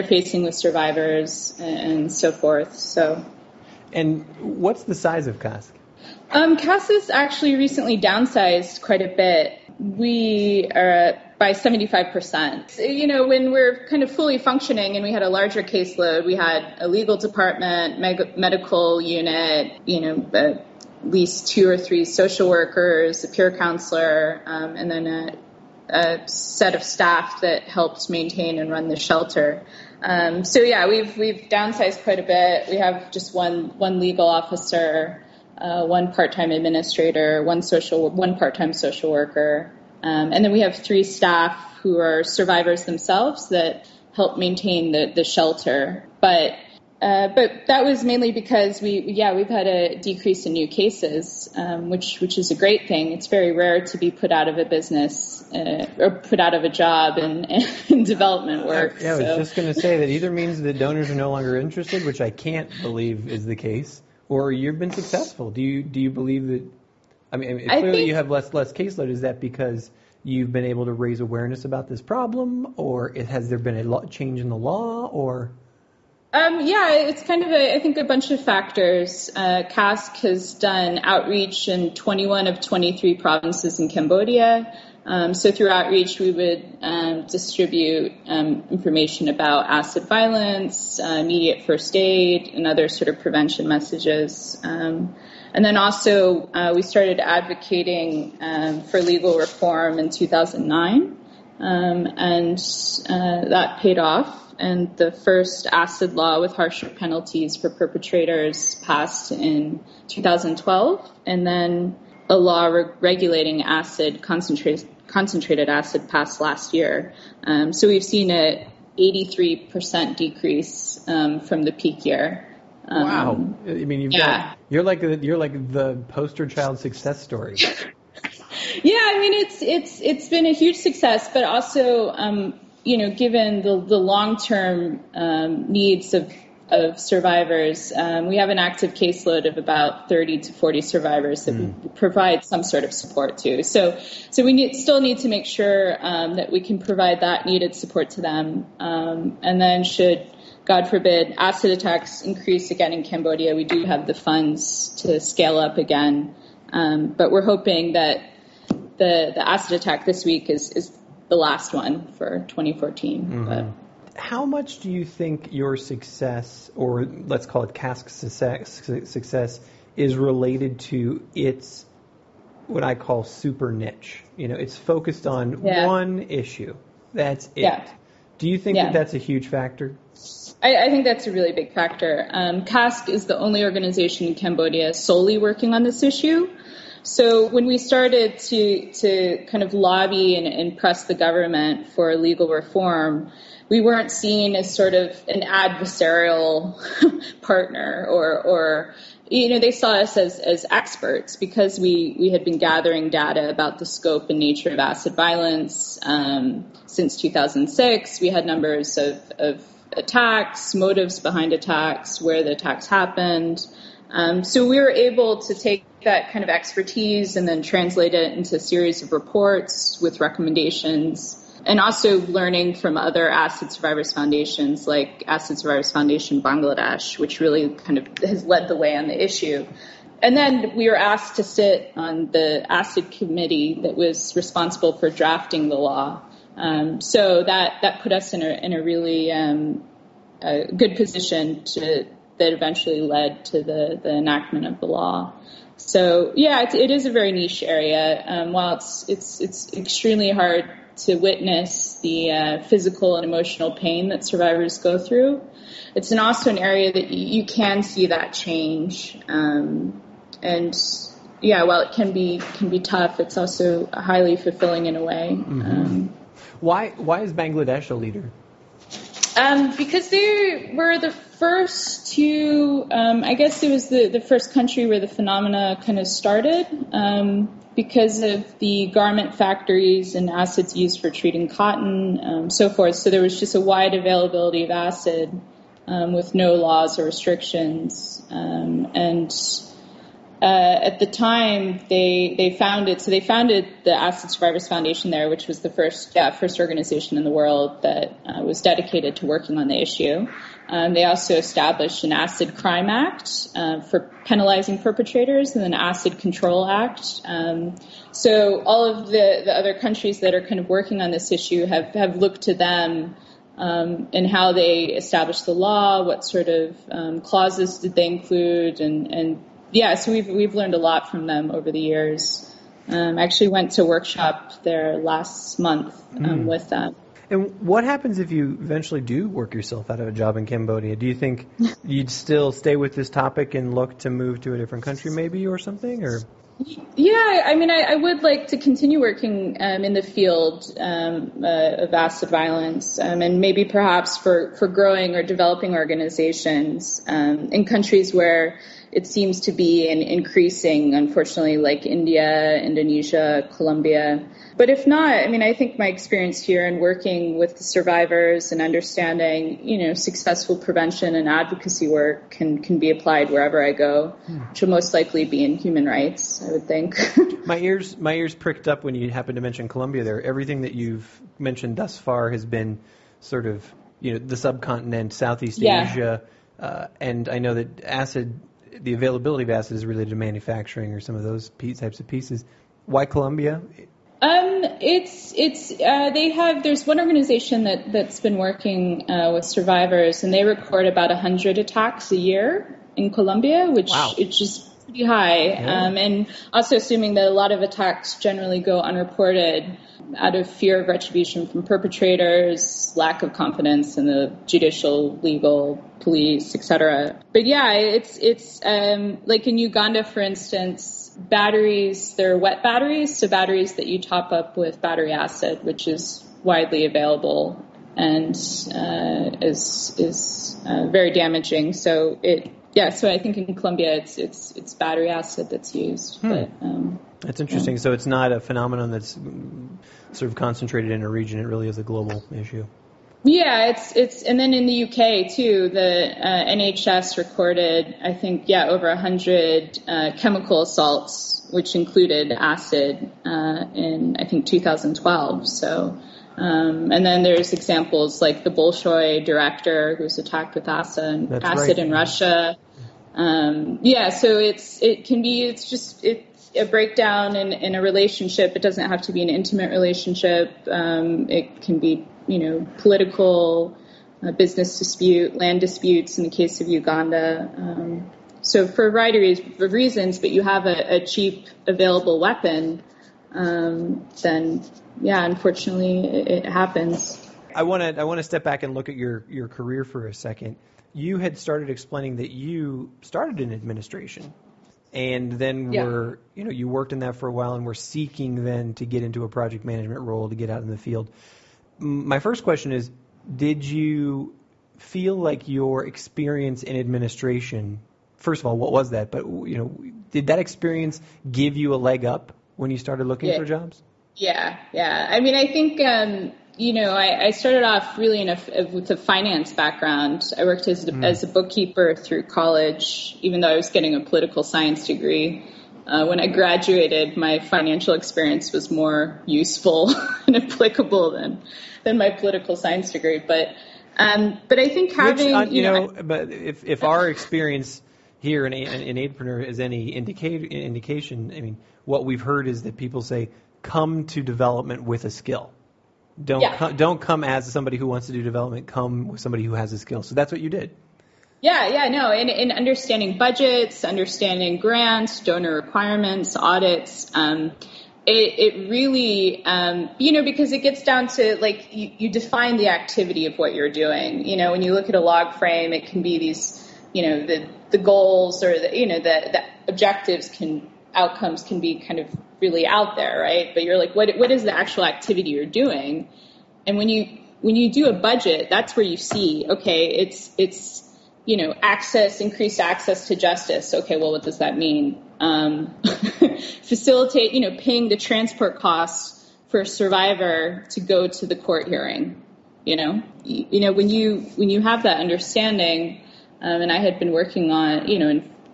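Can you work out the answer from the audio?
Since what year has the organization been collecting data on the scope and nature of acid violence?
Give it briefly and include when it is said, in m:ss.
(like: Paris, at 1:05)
2006, at 3:27.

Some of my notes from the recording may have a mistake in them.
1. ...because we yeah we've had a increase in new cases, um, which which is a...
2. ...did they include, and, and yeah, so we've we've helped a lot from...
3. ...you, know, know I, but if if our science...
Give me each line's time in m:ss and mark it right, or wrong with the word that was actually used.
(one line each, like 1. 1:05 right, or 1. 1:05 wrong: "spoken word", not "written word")
1. 0:48 wrong: "decrease", not "increase"
2. 5:17 wrong: "learned", not "helped"
3. 8:45 wrong: "experience", not "science".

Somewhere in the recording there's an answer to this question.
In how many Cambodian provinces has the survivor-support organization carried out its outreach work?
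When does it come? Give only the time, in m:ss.
1:21.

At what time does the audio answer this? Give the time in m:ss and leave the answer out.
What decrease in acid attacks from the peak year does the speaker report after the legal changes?
1:58.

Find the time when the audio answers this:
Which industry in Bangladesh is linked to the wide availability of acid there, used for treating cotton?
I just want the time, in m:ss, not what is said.
4:38.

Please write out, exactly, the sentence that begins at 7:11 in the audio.
It really is a global issue.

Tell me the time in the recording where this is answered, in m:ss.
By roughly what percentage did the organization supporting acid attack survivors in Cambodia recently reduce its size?
0:11.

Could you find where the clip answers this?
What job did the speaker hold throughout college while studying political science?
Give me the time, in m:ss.
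8:31.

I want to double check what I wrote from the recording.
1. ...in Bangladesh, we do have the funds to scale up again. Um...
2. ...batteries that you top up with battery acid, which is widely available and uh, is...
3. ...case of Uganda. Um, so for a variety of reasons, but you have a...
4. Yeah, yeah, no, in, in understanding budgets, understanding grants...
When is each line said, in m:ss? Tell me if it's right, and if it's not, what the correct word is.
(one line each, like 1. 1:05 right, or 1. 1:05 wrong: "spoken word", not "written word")
1. 2:32 wrong: "Cambodia", not "Bangladesh"
2. 6:53 right
3. 7:46 right
4. 9:01 right.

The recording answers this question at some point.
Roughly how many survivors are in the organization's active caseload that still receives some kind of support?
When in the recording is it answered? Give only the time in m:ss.
2:20.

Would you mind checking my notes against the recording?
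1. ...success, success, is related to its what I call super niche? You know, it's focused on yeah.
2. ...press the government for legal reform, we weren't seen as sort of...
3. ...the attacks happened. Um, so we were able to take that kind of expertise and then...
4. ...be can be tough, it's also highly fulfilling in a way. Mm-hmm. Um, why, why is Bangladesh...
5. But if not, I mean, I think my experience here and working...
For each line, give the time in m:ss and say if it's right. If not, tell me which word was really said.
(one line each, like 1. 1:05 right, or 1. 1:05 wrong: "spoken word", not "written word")
1. 2:48 right
2. 3:10 right
3. 3:32 right
4. 4:22 right
5. 5:54 right.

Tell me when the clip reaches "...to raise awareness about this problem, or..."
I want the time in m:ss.
1:10.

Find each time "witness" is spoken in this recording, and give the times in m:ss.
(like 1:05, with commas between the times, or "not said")
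4:11.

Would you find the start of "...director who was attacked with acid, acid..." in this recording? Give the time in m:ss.
7:29.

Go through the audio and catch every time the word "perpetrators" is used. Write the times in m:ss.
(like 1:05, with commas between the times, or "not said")
1:47, 5:04, 6:41.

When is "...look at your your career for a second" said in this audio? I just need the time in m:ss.
7:58.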